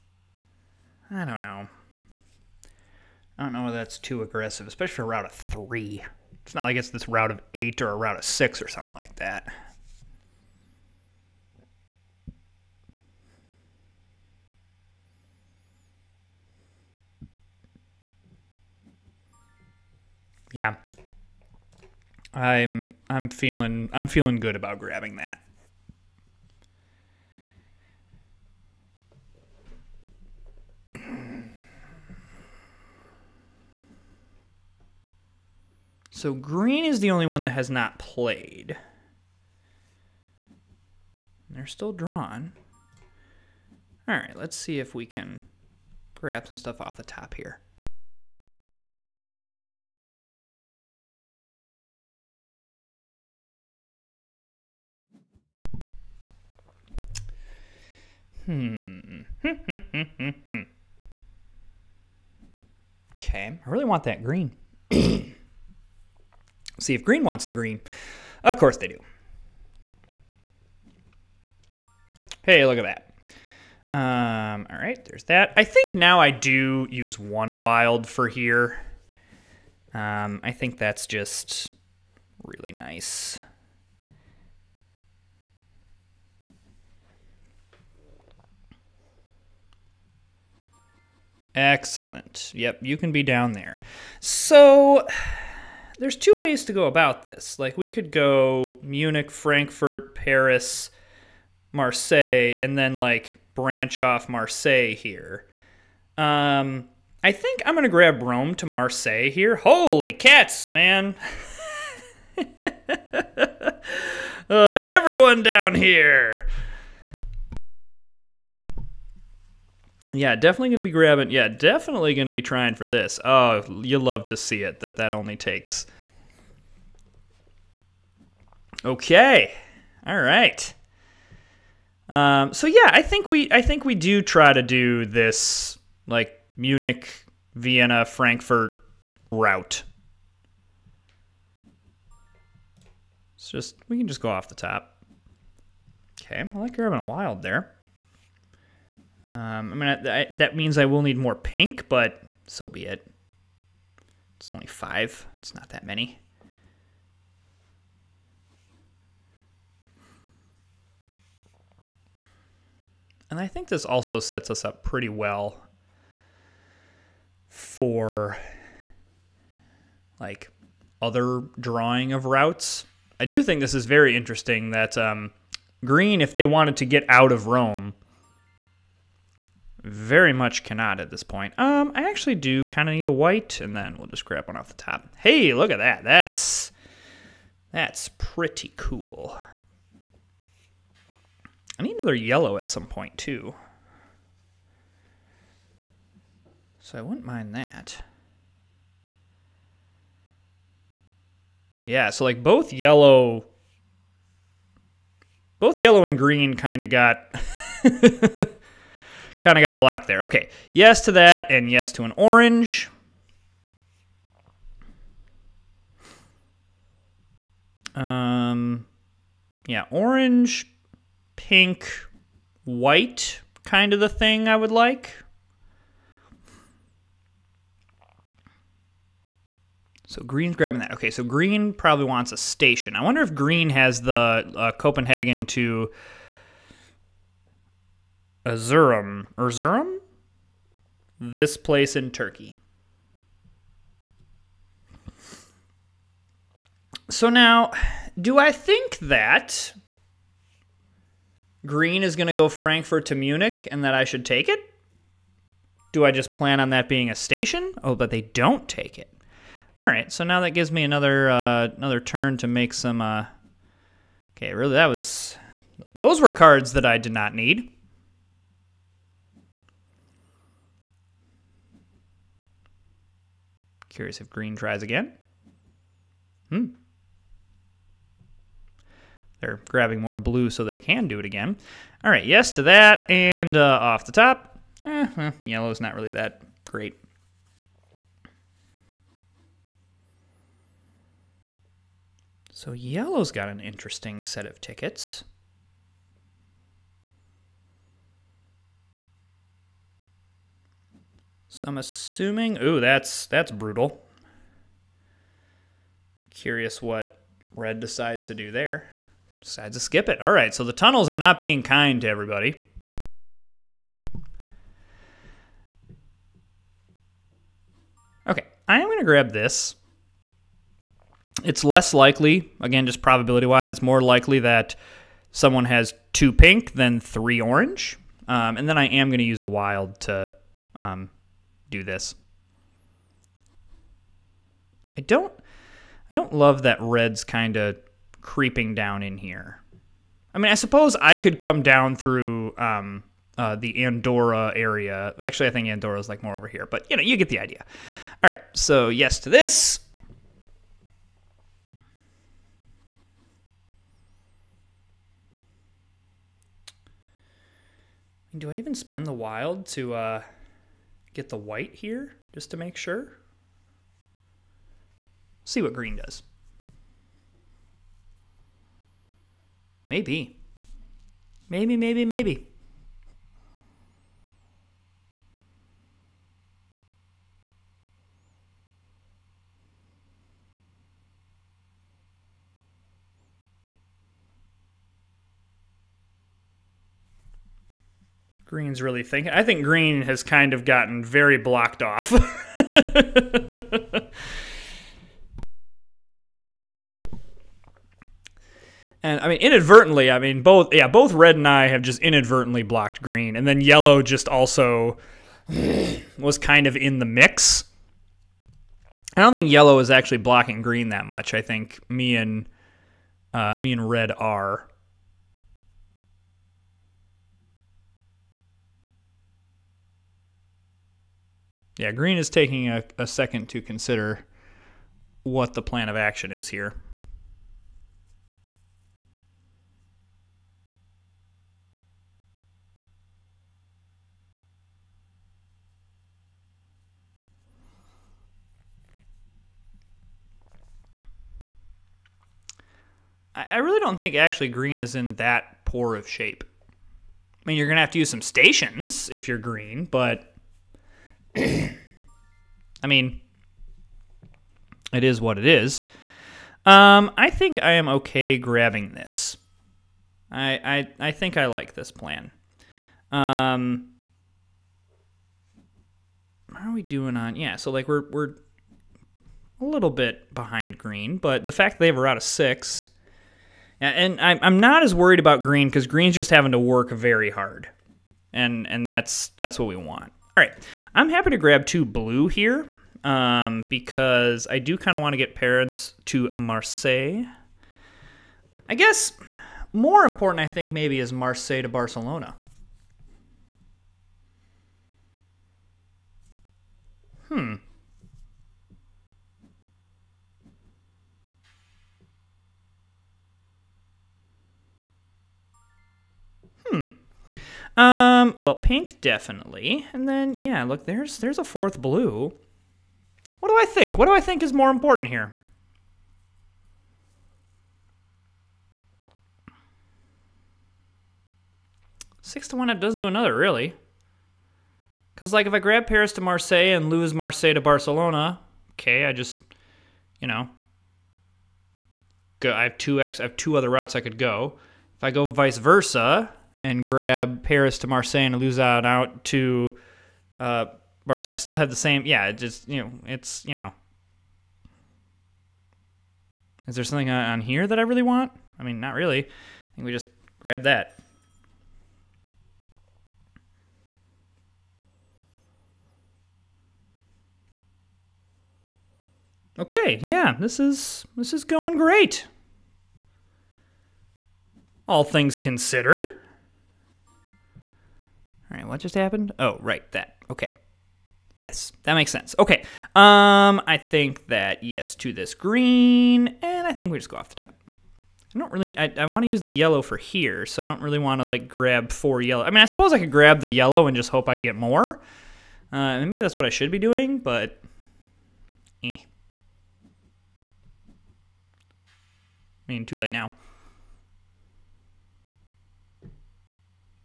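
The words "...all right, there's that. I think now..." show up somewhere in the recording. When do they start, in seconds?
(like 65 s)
74 s.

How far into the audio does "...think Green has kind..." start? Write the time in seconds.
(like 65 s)
389 s.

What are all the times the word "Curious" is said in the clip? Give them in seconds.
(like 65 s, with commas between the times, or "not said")
273 s, 306 s.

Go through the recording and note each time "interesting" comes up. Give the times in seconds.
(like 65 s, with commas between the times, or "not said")
174 s, 293 s.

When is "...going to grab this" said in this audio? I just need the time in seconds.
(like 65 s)
318 s.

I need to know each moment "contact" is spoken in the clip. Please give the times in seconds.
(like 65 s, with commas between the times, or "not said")
not said.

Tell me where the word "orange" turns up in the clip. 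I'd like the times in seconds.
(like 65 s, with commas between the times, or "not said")
212 s, 219 s, 327 s.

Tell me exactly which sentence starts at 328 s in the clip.
Um, and then I am going to use a wild to um, do this.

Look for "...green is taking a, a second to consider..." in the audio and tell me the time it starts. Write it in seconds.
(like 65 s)
421 s.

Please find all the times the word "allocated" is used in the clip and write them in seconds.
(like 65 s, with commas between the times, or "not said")
not said.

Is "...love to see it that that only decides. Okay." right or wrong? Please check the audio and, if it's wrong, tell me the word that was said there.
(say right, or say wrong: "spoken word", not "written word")
wrong: "takes", not "decides".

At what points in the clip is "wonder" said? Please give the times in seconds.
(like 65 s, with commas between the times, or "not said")
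233 s.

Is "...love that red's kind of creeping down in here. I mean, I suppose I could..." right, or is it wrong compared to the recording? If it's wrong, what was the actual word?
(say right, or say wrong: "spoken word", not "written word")
right.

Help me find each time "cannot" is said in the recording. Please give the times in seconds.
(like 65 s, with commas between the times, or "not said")
180 s.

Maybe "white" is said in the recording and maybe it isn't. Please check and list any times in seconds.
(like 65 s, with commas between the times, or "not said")
183 s, 222 s, 361 s.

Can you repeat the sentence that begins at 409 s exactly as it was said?
I don't think yellow is actually blocking green that much.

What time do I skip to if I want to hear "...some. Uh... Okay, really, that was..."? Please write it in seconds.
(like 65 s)
262 s.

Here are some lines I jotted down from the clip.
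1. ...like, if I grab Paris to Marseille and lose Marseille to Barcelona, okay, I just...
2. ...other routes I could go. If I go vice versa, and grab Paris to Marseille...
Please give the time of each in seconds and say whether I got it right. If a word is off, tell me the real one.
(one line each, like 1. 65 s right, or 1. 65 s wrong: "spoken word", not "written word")
1. 525 s right
2. 533 s right.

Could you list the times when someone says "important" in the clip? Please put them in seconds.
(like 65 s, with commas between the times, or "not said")
490 s, 514 s.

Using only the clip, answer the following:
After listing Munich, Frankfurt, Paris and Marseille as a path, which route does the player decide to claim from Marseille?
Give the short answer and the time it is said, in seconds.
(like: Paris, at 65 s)
Rome to Marseille, at 108 s.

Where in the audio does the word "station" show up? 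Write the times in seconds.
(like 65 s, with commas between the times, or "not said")
232 s, 257 s, 448 s.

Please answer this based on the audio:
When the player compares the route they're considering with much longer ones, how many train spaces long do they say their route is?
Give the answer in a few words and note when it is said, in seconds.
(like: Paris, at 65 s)
3, at 5 s.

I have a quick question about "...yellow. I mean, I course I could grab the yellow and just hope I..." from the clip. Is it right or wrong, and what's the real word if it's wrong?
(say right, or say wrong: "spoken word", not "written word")
wrong: "suppose", not "course".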